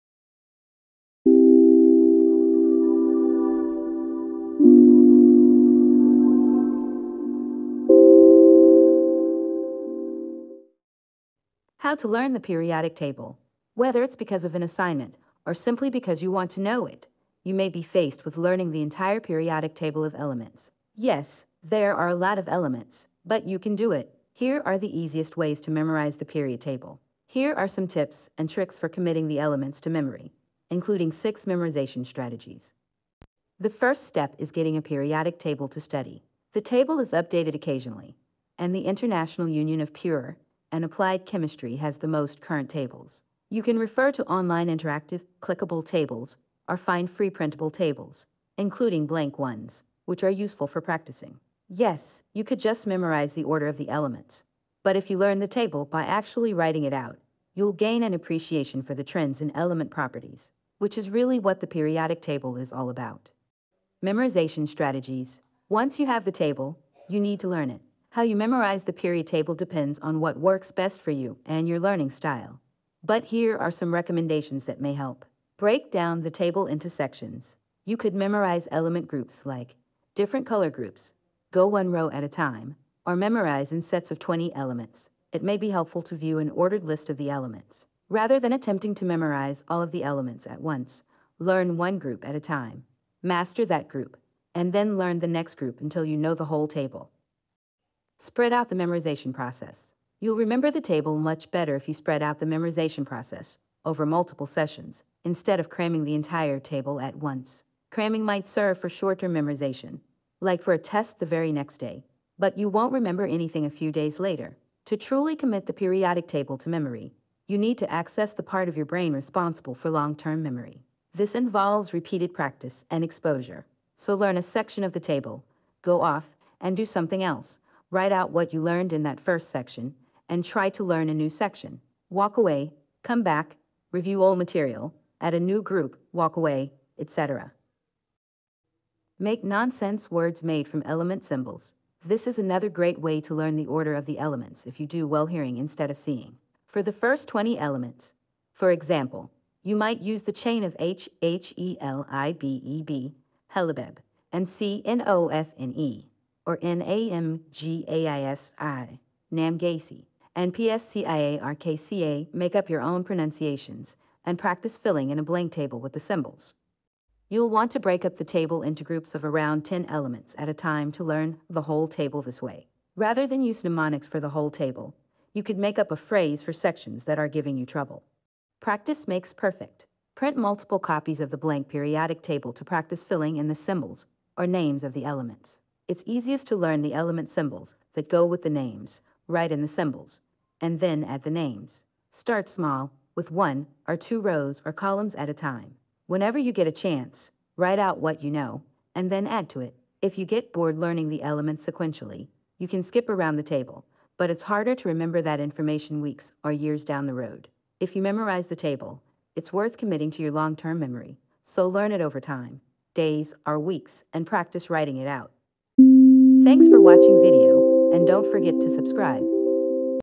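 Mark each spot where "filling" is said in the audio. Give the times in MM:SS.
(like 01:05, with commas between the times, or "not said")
02:44, 03:03.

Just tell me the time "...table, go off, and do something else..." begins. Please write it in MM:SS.
02:04.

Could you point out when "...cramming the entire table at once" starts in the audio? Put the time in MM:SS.
01:45.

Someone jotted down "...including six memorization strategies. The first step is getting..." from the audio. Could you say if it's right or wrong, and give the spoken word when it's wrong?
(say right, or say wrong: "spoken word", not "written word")
right.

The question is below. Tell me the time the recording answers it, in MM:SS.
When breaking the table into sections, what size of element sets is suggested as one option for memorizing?
01:23.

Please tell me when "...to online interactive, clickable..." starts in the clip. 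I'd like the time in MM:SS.
00:44.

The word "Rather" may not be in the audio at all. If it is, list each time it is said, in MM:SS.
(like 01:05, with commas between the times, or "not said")
01:28, 02:52.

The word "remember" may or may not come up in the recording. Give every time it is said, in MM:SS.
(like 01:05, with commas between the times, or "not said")
01:40, 01:52, 03:24.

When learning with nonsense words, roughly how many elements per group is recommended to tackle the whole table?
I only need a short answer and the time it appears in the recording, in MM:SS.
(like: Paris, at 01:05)
10, at 02:49.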